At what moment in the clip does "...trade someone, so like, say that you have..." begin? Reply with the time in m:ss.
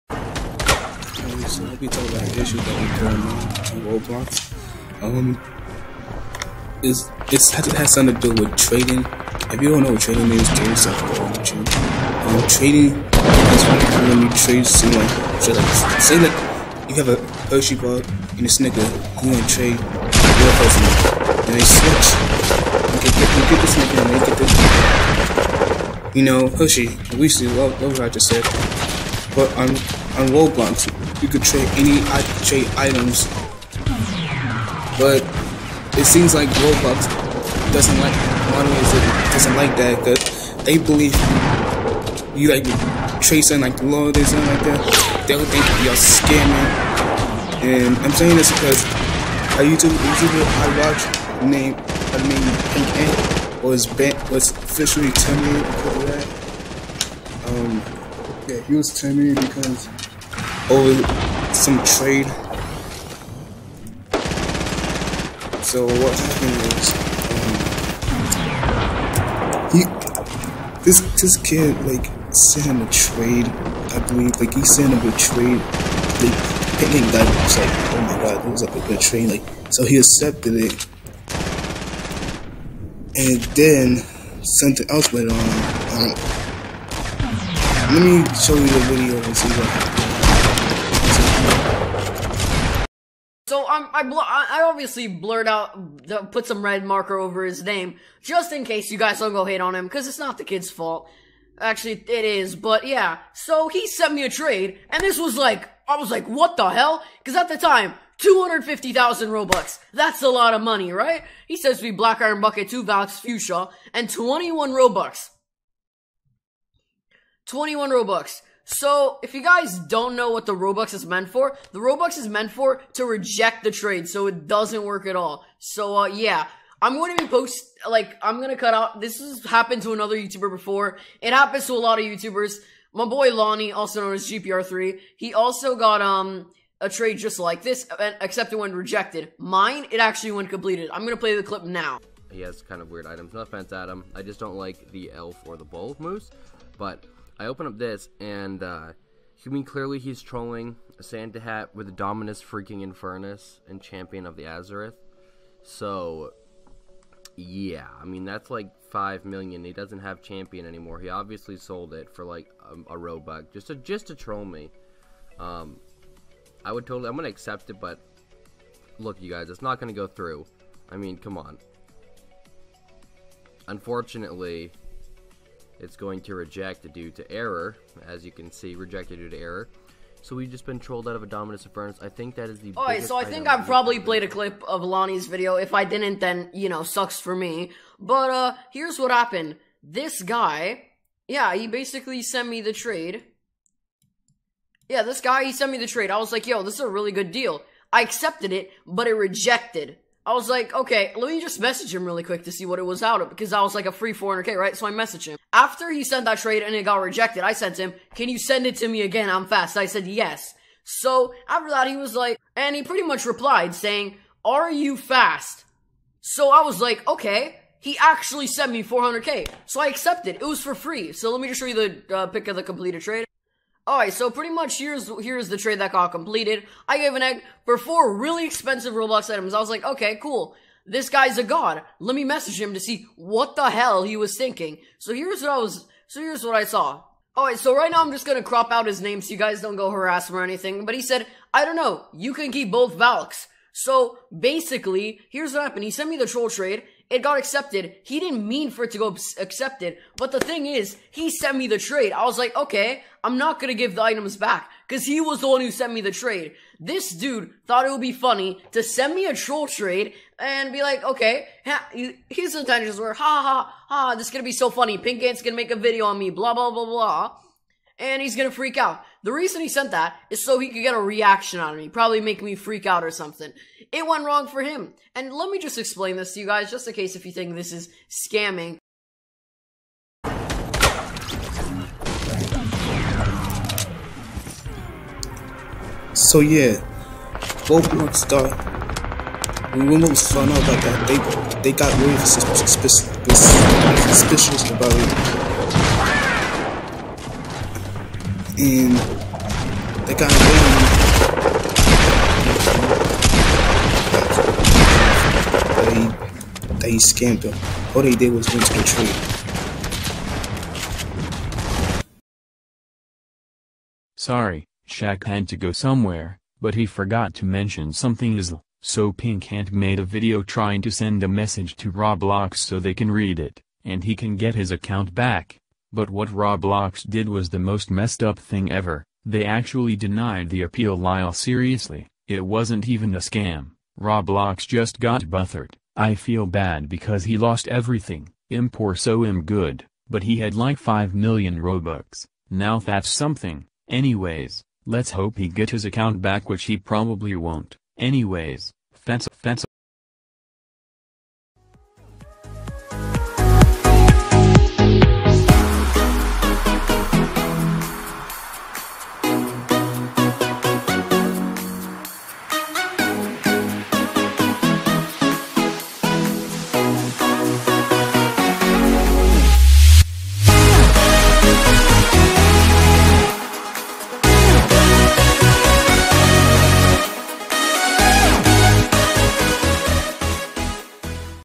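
0:14.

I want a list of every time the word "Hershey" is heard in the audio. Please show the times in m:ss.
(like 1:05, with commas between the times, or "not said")
0:17, 0:26.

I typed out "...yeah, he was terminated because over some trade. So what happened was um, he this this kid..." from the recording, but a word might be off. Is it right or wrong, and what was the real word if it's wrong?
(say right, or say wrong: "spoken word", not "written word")
right.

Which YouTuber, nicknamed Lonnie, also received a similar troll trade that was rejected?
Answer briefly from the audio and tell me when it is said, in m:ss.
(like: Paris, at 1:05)
GPR3, at 2:14.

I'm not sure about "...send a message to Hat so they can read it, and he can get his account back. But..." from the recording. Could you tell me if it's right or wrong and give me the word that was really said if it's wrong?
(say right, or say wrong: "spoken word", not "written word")
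wrong: "Roblox", not "Hat".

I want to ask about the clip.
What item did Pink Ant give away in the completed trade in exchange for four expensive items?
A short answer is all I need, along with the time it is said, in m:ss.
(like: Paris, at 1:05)
an egg, at 3:47.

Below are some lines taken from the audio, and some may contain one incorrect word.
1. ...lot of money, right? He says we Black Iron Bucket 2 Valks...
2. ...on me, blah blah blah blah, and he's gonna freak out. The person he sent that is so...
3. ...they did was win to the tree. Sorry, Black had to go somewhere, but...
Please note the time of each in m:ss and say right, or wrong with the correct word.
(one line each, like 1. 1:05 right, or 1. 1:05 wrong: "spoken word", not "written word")
1. 1:50 right
2. 4:26 wrong: "reason", not "person"
3. 5:08 wrong: "Shaq", not "Black".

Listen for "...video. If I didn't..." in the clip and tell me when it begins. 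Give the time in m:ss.
3:05.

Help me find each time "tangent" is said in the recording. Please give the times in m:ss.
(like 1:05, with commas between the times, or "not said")
not said.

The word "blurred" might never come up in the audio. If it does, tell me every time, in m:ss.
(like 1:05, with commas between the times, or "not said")
1:35.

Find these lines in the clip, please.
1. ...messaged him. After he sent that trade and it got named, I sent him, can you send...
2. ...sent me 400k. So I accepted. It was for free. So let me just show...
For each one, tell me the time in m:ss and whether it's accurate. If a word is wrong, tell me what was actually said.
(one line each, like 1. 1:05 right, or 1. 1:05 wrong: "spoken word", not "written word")
1. 3:24 wrong: "rejected", not "named"
2. 3:38 right.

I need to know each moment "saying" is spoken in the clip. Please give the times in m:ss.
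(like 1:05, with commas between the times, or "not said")
0:48, 3:33.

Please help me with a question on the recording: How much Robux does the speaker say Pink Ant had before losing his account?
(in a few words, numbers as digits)
5 million.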